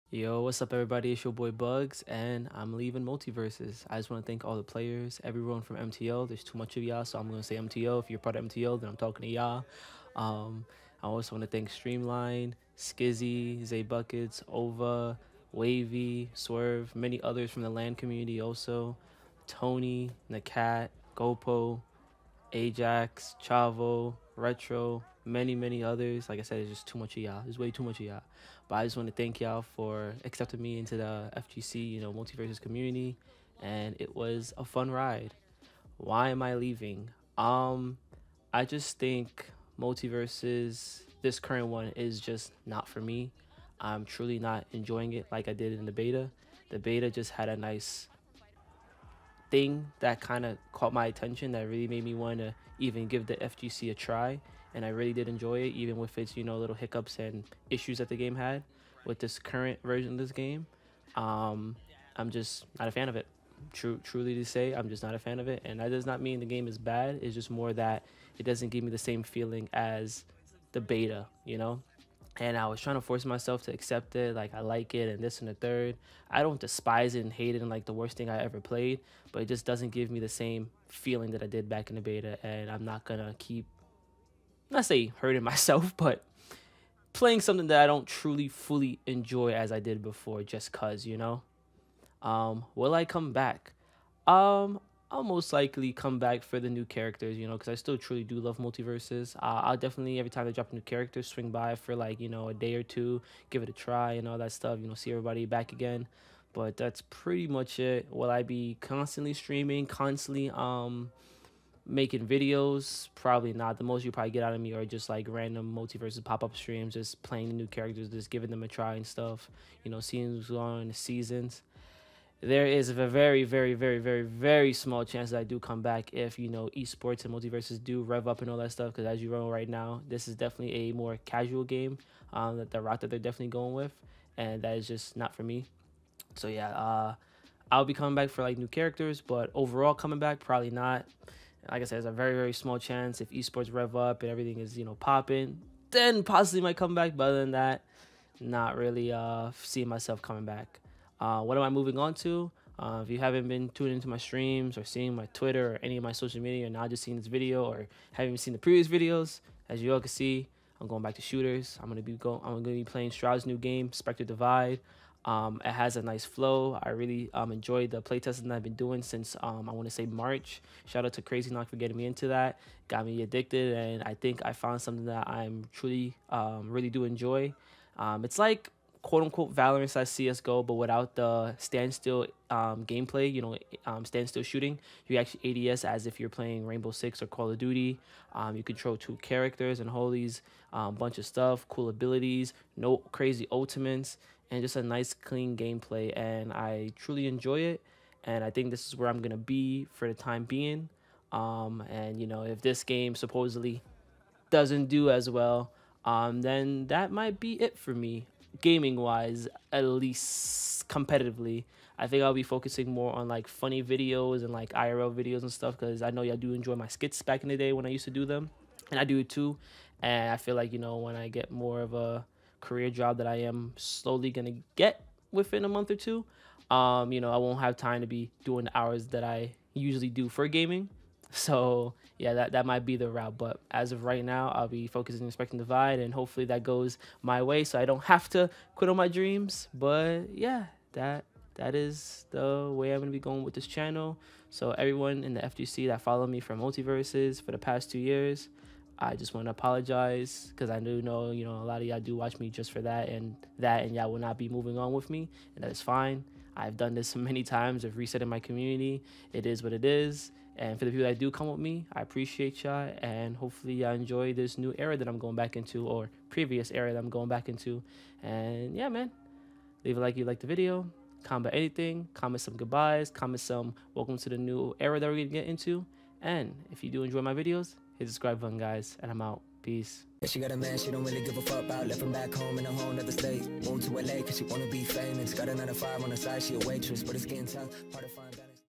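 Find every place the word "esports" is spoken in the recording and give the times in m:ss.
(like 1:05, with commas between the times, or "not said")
2:06, 2:23.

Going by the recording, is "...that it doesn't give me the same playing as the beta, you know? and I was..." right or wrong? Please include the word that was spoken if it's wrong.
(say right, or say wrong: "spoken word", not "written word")
wrong: "feeling", not "playing".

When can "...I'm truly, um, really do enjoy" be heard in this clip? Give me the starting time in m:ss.
2:55.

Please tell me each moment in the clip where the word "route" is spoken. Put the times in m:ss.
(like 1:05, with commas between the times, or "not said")
2:12, 3:53.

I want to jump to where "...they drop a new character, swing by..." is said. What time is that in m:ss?
1:40.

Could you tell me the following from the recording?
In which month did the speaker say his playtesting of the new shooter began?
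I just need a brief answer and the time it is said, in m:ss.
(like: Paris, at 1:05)
March, at 2:50.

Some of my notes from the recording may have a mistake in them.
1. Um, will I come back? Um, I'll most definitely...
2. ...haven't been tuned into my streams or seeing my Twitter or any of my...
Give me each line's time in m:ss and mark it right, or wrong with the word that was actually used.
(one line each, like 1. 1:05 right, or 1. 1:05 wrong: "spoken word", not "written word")
1. 1:32 wrong: "likely", not "definitely"
2. 2:33 right.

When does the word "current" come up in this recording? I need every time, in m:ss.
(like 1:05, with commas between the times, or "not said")
0:41, 0:59.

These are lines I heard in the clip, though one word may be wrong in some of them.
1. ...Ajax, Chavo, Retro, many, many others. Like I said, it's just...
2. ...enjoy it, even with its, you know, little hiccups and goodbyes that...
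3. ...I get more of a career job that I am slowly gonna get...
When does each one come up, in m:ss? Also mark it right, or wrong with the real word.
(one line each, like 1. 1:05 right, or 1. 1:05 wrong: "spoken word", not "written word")
1. 0:22 right
2. 0:55 wrong: "issues", not "goodbyes"
3. 3:41 right.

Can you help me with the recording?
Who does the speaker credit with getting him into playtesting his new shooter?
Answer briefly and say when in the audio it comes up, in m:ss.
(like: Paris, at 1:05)
Crazy Knock, at 2:51.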